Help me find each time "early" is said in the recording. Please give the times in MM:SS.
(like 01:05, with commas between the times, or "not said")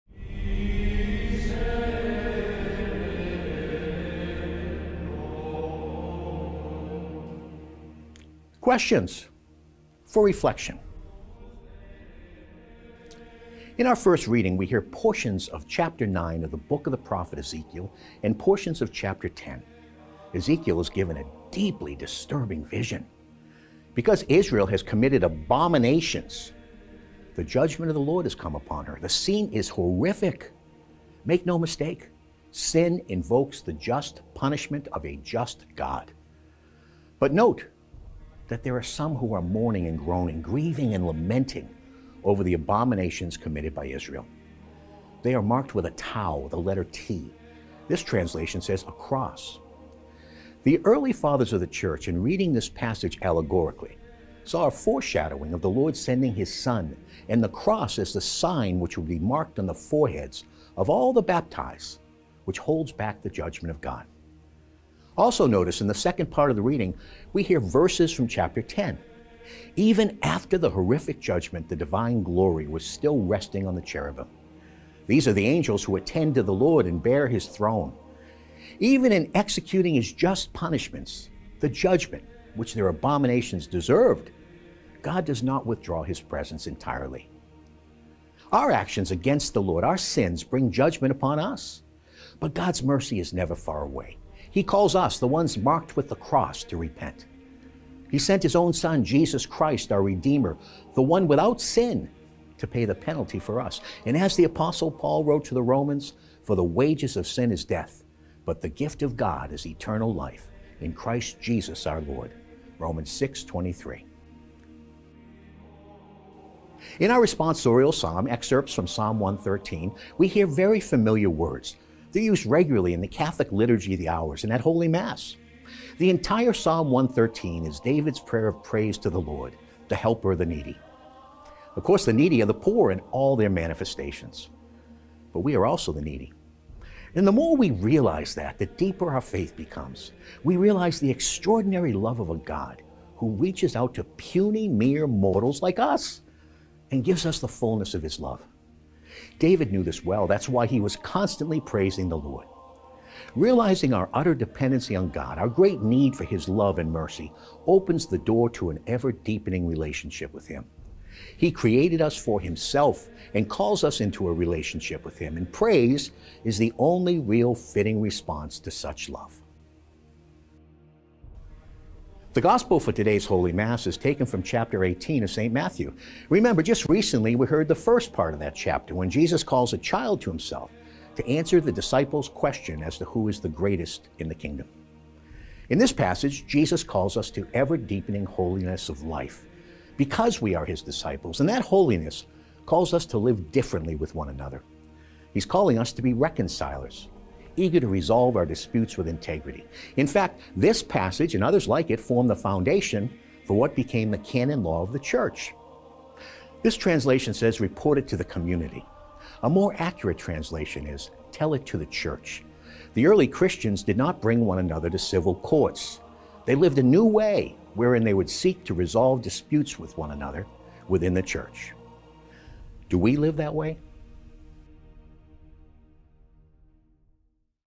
00:50, 03:33.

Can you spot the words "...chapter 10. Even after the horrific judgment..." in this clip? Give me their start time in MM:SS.
01:08.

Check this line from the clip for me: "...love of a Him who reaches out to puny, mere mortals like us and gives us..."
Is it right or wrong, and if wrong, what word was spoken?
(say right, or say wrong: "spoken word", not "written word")
wrong: "God", not "Him".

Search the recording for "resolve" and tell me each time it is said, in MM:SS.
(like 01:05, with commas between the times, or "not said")
03:17, 03:38.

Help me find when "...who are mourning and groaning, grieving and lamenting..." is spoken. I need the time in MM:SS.
00:39.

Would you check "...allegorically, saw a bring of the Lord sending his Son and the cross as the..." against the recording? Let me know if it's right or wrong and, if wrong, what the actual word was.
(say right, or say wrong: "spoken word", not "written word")
wrong: "foreshadowing", not "bring".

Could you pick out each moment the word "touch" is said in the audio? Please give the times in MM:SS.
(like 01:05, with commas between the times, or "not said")
not said.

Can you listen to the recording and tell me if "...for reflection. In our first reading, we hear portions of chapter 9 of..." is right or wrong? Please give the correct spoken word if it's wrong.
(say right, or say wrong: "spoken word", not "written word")
right.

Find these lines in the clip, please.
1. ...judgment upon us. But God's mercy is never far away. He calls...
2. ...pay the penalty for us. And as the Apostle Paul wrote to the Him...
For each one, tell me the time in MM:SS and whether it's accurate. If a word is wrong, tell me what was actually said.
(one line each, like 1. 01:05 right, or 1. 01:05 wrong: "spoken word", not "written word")
1. 01:30 right
2. 01:42 wrong: "Romans", not "Him".